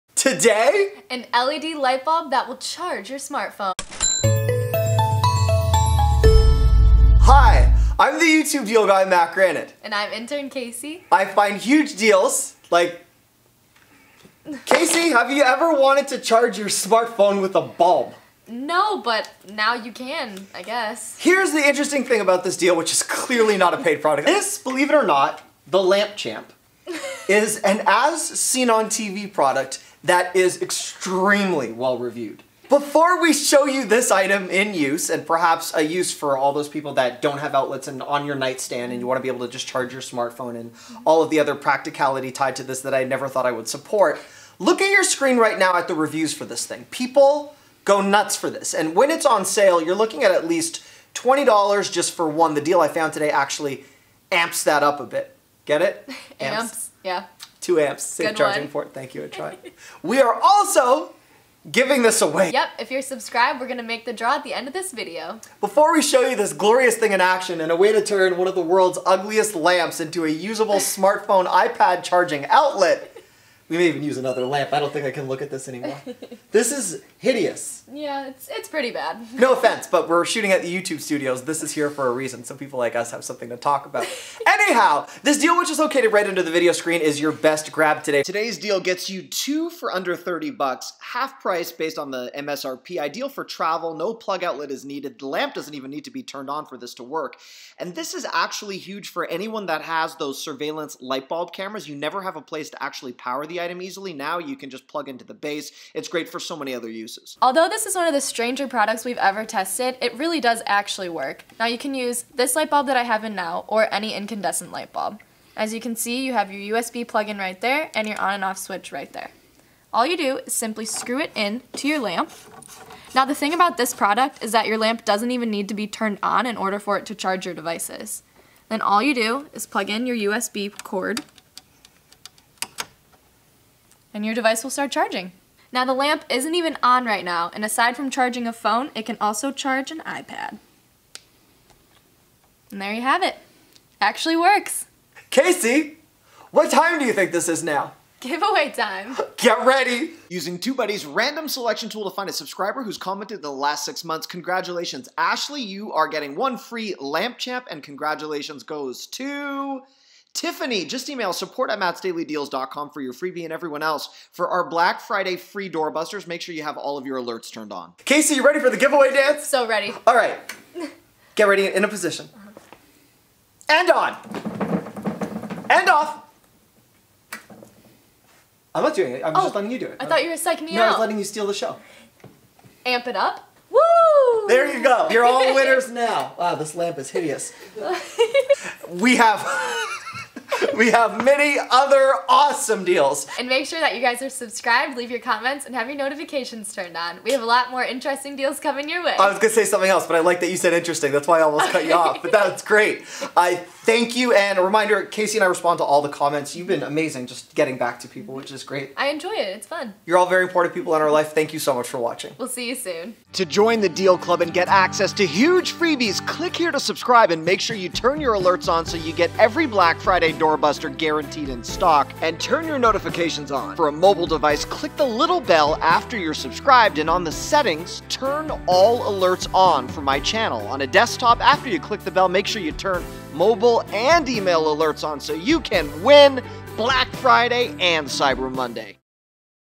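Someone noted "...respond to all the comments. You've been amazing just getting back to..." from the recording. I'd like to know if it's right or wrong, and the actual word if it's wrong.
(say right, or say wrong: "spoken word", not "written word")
right.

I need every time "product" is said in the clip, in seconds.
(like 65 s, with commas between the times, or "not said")
24 s, 29 s, 108 s, 123 s.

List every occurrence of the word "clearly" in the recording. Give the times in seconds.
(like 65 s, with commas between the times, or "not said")
23 s.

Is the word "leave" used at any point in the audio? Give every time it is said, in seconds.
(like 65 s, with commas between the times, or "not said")
194 s.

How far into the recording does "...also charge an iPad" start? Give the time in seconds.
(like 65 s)
139 s.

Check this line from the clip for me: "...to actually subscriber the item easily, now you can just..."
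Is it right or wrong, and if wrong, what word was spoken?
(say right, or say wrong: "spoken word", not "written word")
wrong: "power", not "subscriber".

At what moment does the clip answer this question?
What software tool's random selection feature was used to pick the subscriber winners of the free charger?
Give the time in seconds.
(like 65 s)
150 s.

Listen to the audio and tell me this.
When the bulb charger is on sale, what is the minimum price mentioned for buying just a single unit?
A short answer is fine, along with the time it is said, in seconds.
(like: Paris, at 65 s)
$20, at 51 s.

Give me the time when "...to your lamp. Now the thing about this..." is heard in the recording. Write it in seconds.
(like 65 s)
121 s.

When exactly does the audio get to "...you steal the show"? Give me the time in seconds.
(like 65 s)
181 s.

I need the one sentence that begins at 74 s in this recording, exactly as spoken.
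I don't think I can look at this anymore.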